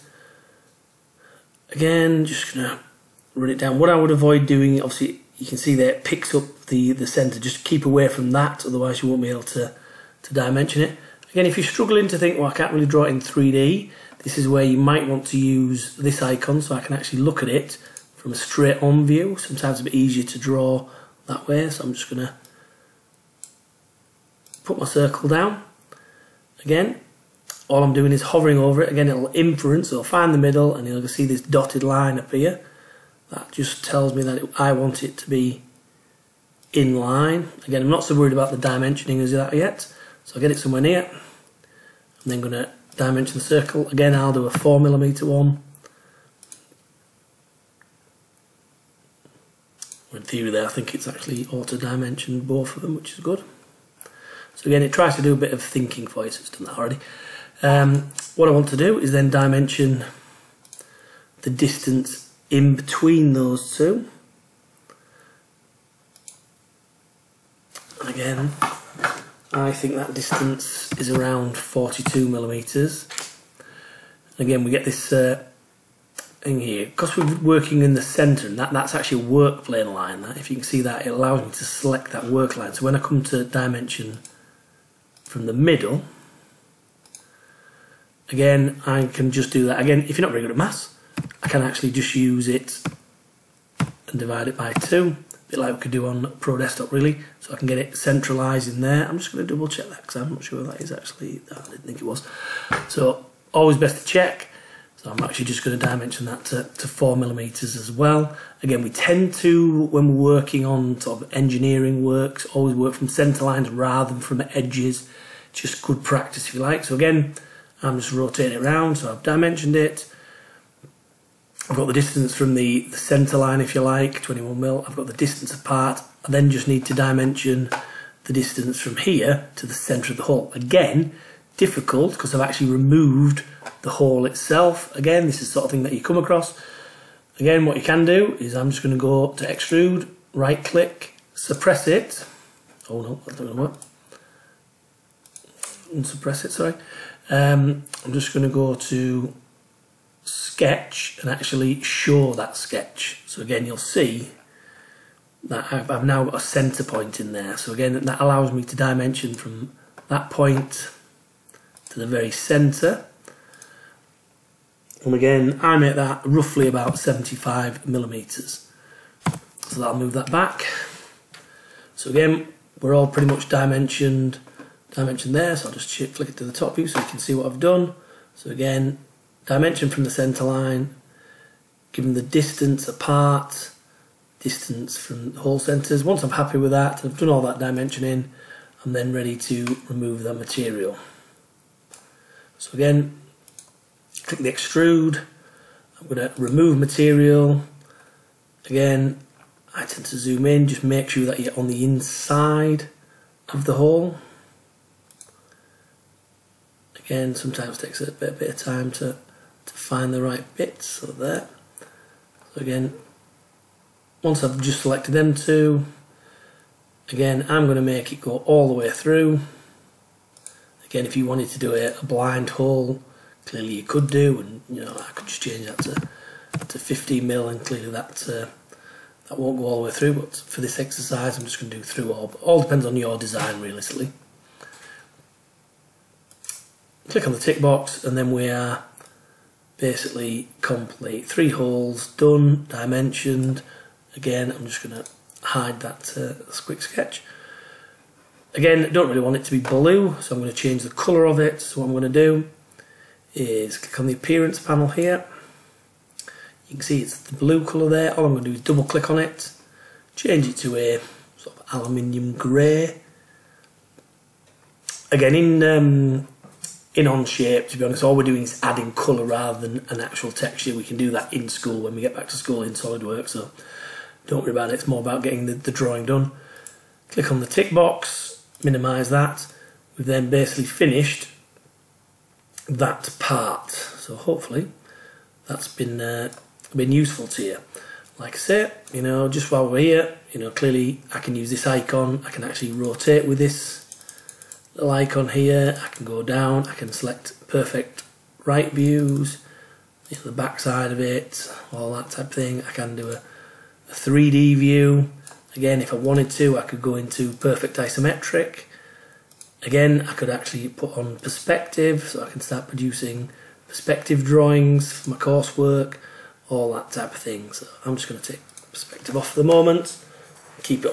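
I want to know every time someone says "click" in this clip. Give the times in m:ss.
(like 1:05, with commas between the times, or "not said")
2:20, 3:14, 3:57, 4:13, 4:18, 4:37.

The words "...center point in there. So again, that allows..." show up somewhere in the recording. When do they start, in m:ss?
2:36.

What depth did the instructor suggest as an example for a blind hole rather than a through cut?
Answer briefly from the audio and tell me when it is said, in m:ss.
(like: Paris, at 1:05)
50 mil, at 3:46.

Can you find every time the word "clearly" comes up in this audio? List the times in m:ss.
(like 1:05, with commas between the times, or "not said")
3:43, 3:47, 4:50.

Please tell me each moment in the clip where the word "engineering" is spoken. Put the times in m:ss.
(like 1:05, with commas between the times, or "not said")
1:51.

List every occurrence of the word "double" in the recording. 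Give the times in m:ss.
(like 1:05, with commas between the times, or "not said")
1:39, 4:18.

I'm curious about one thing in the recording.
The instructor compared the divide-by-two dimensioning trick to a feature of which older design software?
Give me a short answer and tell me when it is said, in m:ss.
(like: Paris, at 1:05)
Pro Desktop, at 1:36.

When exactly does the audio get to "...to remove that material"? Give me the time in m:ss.
3:09.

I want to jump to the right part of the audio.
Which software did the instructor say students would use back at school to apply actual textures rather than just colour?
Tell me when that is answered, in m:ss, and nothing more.
4:32.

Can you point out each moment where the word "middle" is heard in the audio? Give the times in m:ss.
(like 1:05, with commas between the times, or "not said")
0:30, 1:25.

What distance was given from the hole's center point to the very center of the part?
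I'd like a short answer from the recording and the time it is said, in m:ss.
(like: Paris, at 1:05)
75 millimeters, at 2:46.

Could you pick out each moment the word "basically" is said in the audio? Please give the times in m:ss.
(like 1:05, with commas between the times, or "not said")
3:59, 4:40.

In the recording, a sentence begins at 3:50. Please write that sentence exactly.
But for this exercise, I'm just going to do through all.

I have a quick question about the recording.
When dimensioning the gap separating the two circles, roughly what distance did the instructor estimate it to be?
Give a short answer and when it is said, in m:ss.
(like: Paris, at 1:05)
42 millimeters, at 1:11.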